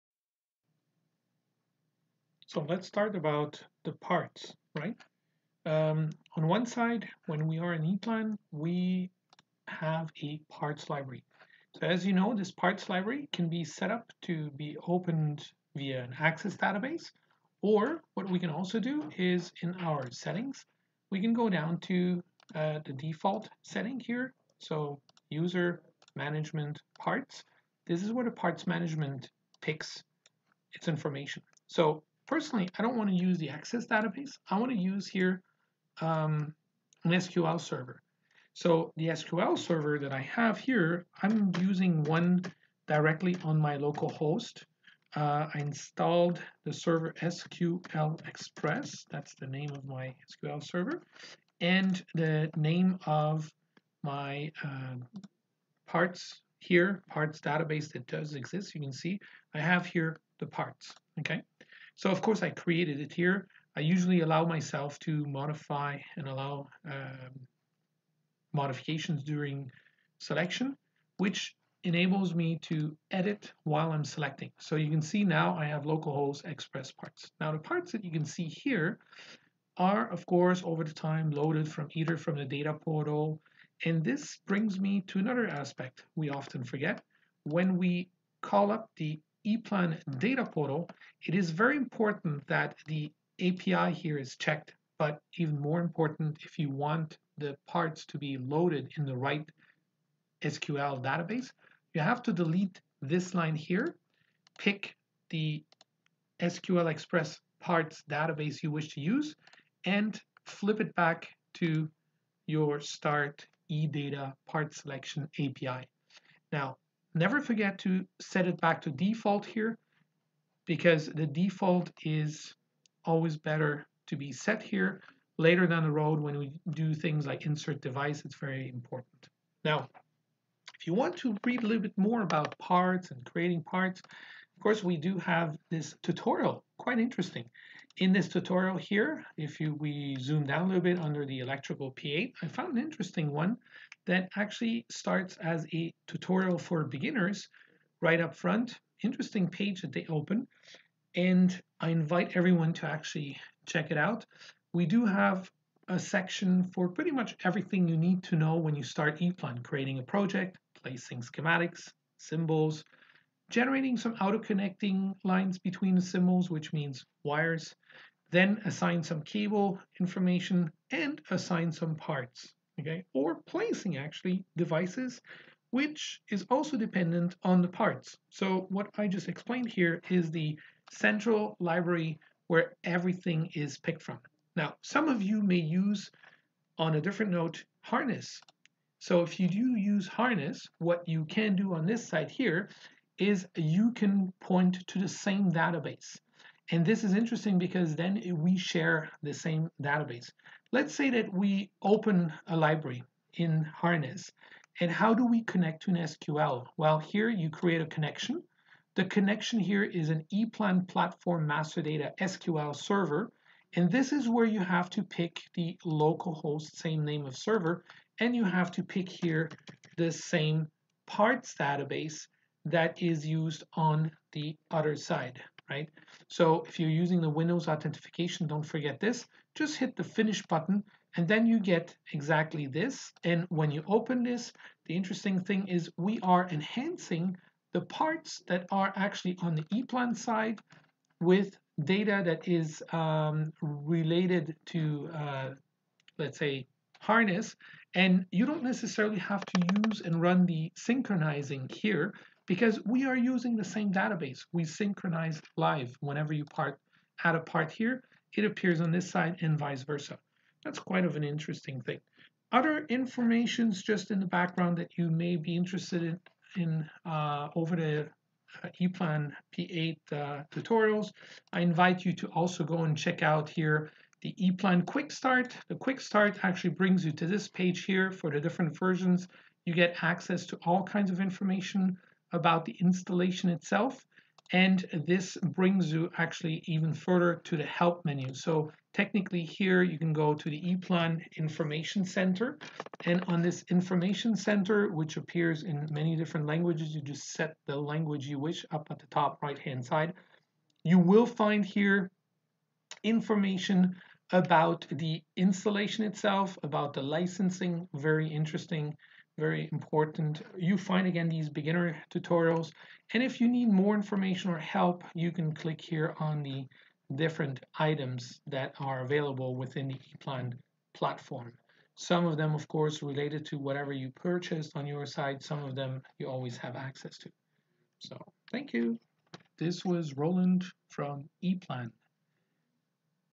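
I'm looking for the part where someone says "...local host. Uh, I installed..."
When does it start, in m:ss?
0:43.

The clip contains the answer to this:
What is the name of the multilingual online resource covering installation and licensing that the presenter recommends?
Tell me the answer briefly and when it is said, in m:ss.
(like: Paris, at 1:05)
ePlan Information Center, at 4:50.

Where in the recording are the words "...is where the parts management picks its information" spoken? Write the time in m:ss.
0:28.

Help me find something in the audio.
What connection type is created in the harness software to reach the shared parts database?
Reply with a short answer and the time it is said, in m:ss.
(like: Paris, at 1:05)
ePlan platform master data SQL server, at 3:30.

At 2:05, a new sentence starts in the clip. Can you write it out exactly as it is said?
Later down the road, when we do things like insert device, it's very important.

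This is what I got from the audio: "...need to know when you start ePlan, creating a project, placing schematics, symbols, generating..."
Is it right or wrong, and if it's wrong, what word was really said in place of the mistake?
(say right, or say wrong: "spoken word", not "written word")
right.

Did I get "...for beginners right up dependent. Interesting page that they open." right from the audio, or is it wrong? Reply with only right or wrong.
wrong.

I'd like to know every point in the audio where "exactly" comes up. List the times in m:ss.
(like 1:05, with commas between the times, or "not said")
3:52.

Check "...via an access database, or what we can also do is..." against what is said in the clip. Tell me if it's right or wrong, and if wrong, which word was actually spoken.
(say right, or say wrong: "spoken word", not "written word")
right.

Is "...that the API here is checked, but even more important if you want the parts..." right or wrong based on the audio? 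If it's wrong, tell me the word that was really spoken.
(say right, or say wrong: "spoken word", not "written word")
right.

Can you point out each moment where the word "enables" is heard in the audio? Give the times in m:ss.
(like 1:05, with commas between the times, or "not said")
1:11.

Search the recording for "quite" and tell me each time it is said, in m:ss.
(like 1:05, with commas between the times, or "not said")
2:16, 4:20.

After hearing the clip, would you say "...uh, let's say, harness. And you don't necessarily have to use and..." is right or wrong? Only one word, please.
right.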